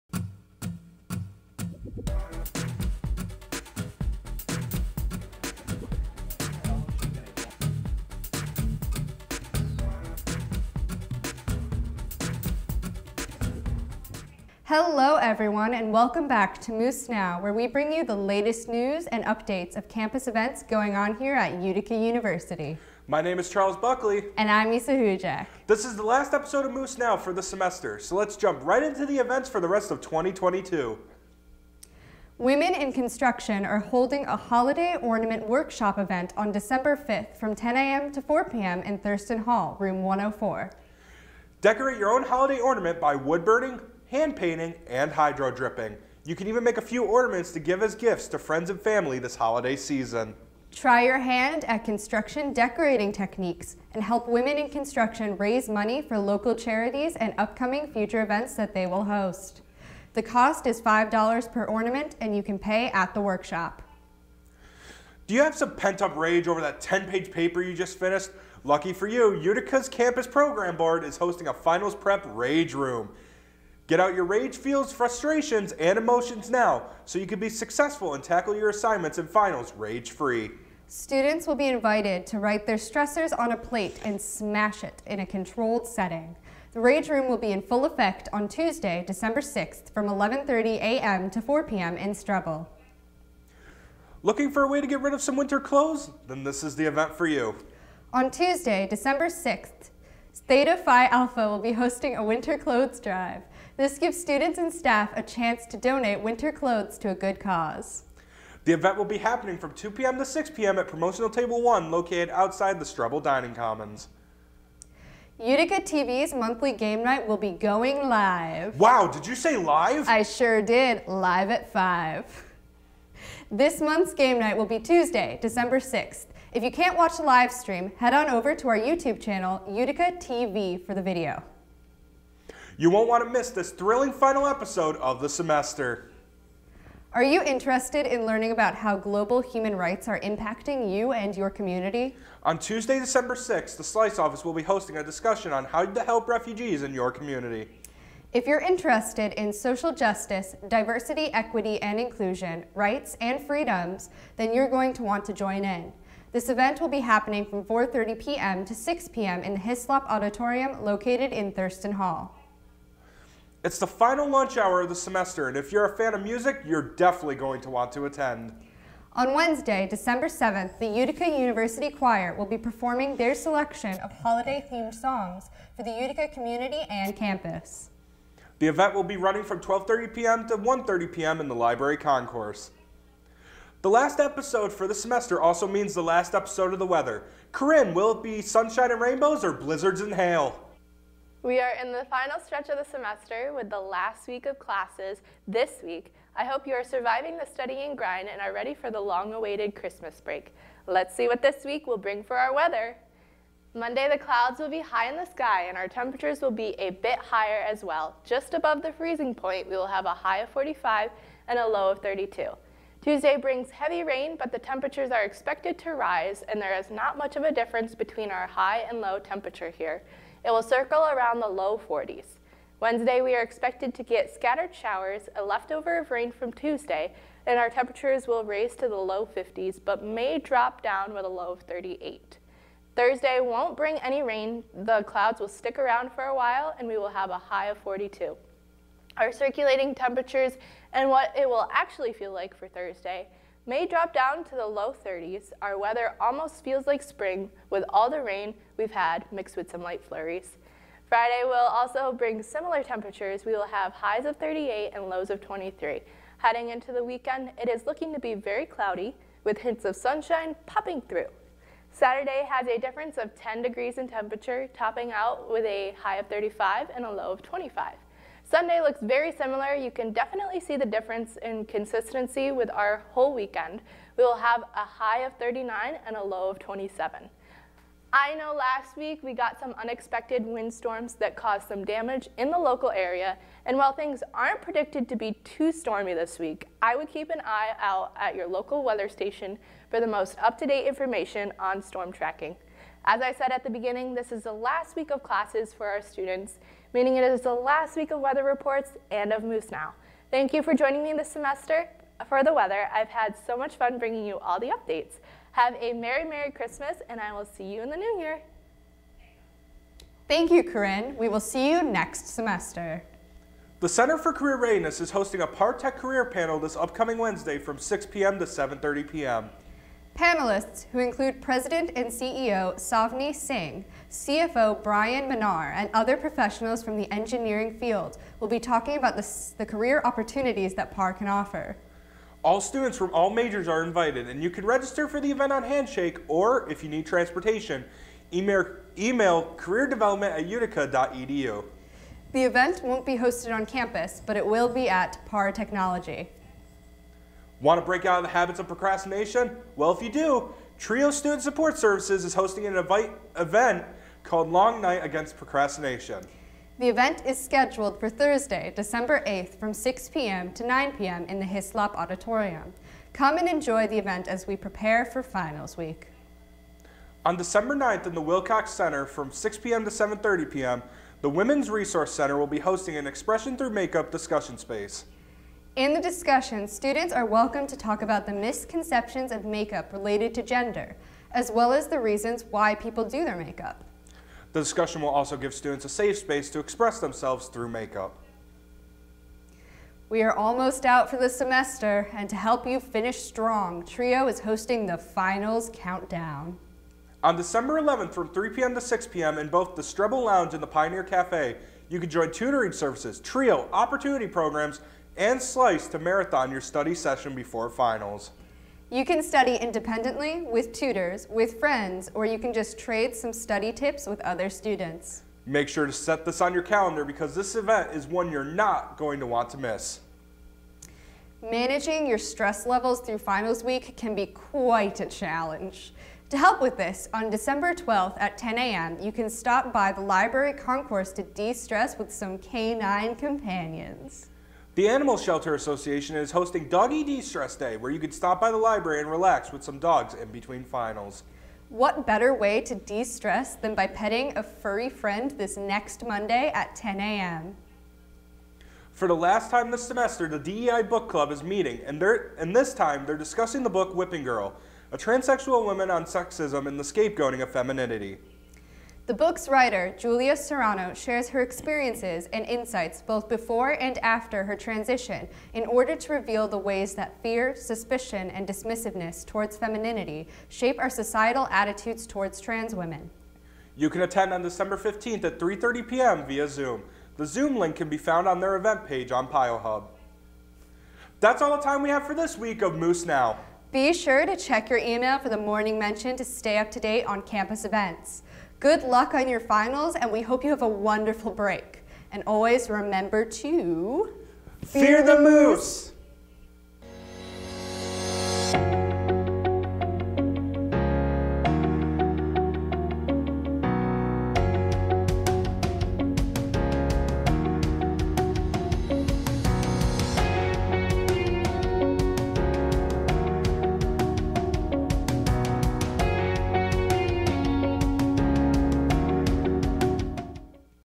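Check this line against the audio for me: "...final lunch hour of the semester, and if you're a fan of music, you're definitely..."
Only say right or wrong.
right.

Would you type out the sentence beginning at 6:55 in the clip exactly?
Make sure to set this on your calendar because this event is one you're not going to want to miss.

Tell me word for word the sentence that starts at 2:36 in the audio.
This event will be happening from 4.30 p.m.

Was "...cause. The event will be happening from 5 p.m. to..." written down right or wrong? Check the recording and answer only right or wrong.
wrong.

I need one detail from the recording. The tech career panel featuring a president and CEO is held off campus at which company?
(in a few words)
PAR Technology.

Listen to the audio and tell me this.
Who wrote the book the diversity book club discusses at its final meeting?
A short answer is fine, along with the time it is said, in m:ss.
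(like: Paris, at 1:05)
Julia Serano, at 7:39.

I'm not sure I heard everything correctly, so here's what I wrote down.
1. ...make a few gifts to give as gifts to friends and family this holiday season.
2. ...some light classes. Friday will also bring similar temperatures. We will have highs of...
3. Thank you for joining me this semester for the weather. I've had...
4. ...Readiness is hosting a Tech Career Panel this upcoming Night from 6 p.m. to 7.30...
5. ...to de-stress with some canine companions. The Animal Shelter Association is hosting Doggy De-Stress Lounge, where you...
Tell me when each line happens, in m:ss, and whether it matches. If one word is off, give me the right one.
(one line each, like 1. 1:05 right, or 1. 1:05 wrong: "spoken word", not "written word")
1. 0:46 wrong: "ornaments", not "gifts"
2. 4:09 wrong: "flurries", not "classes"
3. 5:00 right
4. 5:14 wrong: "Wednesday", not "Night"
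5. 7:11 wrong: "Day", not "Lounge".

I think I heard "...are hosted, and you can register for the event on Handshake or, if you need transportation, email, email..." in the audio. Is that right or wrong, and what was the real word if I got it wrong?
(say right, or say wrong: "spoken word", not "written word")
wrong: "invited", not "hosted".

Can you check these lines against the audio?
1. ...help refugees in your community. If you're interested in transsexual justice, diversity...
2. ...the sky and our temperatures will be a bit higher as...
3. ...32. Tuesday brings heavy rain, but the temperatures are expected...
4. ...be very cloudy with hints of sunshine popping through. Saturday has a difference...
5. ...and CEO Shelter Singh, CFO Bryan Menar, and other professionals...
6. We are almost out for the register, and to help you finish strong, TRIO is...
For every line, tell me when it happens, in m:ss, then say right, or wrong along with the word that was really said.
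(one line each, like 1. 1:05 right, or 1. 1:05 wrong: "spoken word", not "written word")
1. 2:26 wrong: "social", not "transsexual"
2. 3:25 right
3. 3:32 right
4. 4:18 right
5. 5:21 wrong: "Savneet", not "Shelter"
6. 6:30 wrong: "semester", not "register".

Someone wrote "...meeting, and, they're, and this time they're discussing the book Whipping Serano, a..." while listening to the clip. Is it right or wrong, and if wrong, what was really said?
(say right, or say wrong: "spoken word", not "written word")
wrong: "Girl", not "Serano".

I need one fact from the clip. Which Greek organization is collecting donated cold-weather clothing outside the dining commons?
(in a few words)
Theta Phi Alpha.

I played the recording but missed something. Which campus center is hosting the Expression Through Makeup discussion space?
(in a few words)
Women's Resource Center.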